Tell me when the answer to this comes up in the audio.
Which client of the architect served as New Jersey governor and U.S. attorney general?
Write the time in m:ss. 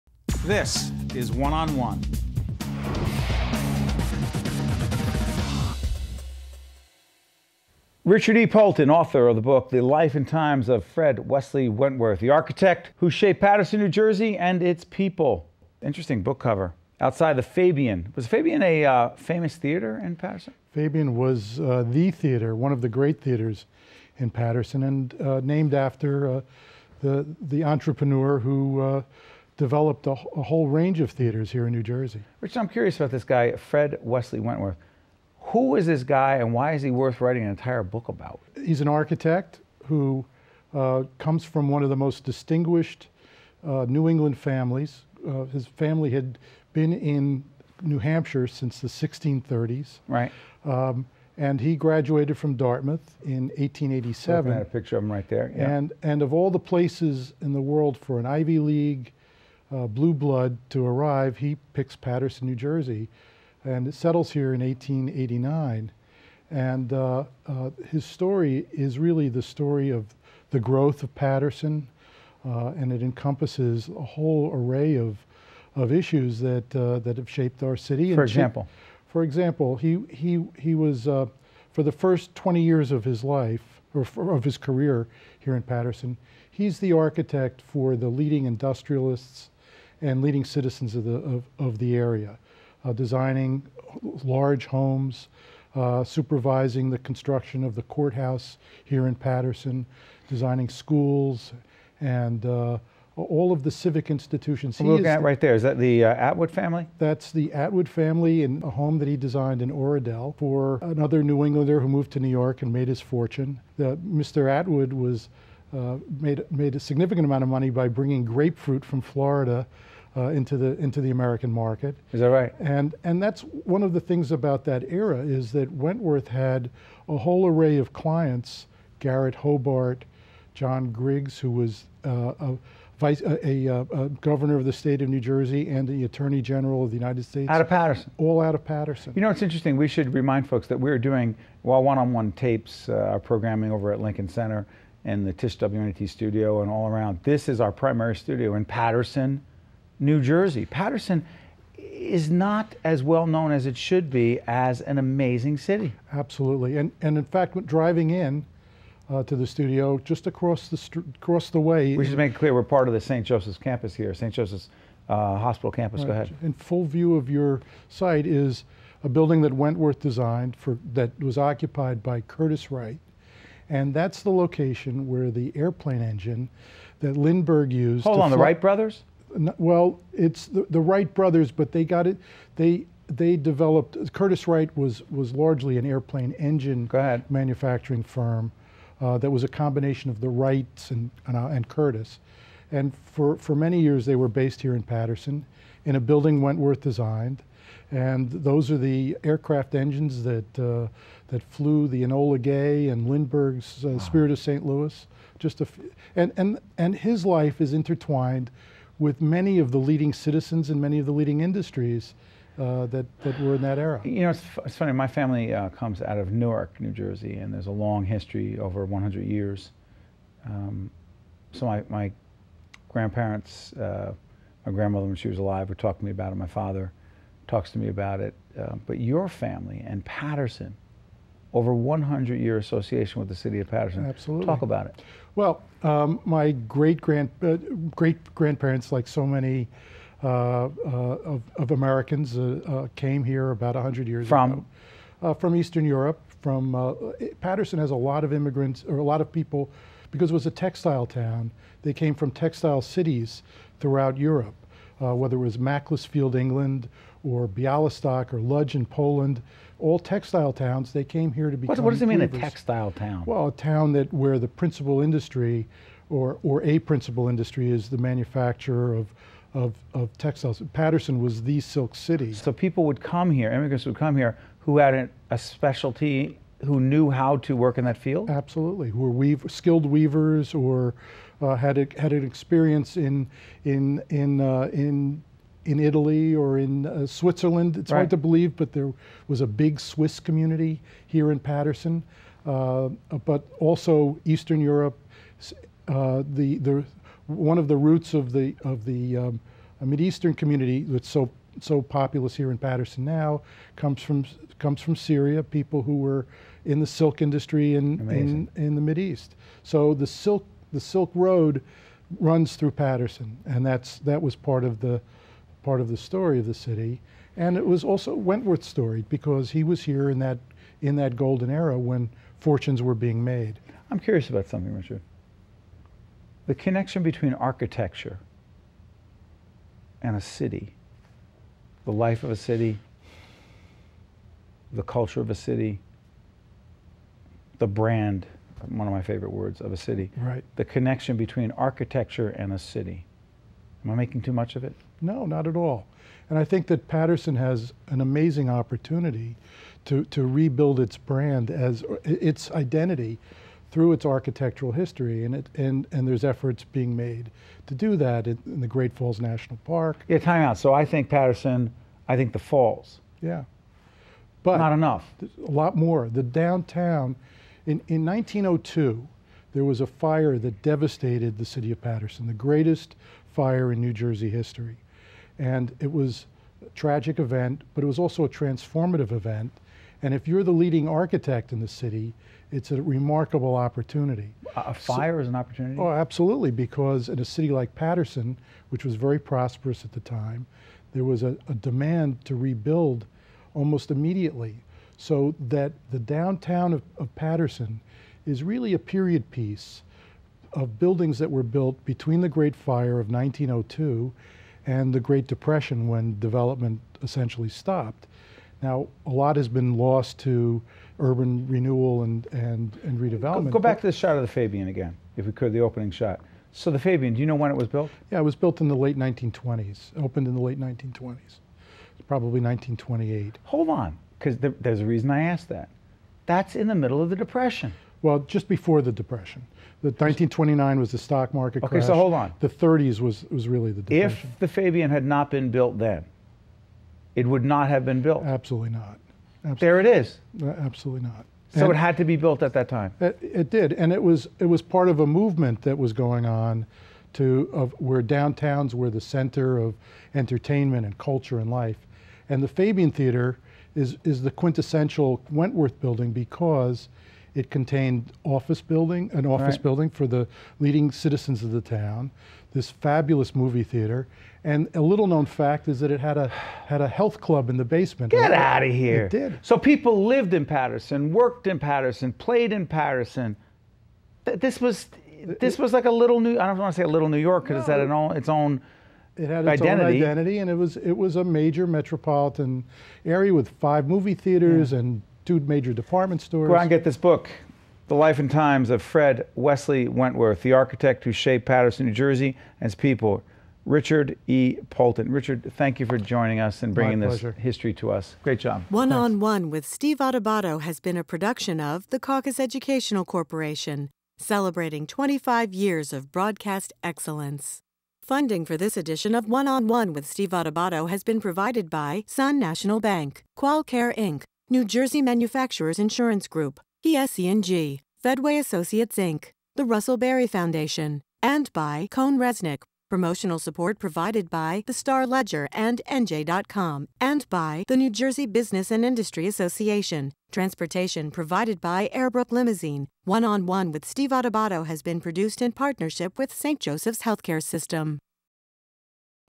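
2:10.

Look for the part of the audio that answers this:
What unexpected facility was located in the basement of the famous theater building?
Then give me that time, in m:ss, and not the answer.
7:46.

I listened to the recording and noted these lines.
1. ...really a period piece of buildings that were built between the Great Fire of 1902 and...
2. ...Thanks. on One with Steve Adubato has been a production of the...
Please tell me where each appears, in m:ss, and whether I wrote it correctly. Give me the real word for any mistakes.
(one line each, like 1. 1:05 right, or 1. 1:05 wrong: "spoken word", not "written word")
1. 6:38 right
2. 8:18 right.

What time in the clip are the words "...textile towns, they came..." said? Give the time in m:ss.
4:19.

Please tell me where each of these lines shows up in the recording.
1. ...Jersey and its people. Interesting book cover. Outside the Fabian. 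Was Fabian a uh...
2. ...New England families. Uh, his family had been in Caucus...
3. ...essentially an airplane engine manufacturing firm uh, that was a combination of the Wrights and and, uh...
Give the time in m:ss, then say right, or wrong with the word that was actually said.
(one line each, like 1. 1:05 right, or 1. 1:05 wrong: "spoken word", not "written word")
1. 0:13 right
2. 0:43 wrong: "New", not "Caucus"
3. 3:05 wrong: "largely", not "essentially".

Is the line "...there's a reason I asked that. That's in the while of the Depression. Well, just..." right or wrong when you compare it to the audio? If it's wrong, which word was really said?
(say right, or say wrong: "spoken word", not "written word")
wrong: "middle", not "while".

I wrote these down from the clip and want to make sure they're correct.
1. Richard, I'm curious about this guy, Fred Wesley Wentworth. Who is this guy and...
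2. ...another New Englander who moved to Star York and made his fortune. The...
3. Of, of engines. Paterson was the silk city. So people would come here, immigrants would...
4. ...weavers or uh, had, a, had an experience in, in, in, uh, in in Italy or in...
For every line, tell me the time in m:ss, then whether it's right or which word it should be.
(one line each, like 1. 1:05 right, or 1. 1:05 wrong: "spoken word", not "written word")
1. 0:32 right
2. 1:50 wrong: "New", not "Star"
3. 4:29 wrong: "textiles", not "engines"
4. 4:39 right.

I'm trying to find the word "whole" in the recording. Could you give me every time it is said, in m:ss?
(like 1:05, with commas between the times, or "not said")
0:30, 1:14, 2:07.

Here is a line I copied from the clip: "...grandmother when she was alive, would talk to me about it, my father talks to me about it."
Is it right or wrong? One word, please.
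right.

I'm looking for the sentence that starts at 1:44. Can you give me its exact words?
I'm looking at right there, is that the uh, Atwood family?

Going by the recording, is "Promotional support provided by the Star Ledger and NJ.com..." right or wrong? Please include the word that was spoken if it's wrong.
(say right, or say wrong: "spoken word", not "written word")
right.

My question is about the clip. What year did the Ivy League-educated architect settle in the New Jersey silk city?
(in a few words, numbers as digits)
1889.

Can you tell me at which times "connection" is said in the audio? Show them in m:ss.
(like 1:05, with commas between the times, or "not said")
5:26, 5:40.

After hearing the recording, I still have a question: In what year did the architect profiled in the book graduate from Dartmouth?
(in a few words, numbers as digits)
1887.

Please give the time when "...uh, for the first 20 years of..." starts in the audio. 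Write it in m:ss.
1:21.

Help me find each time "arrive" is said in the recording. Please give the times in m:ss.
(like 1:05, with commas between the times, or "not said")
1:00.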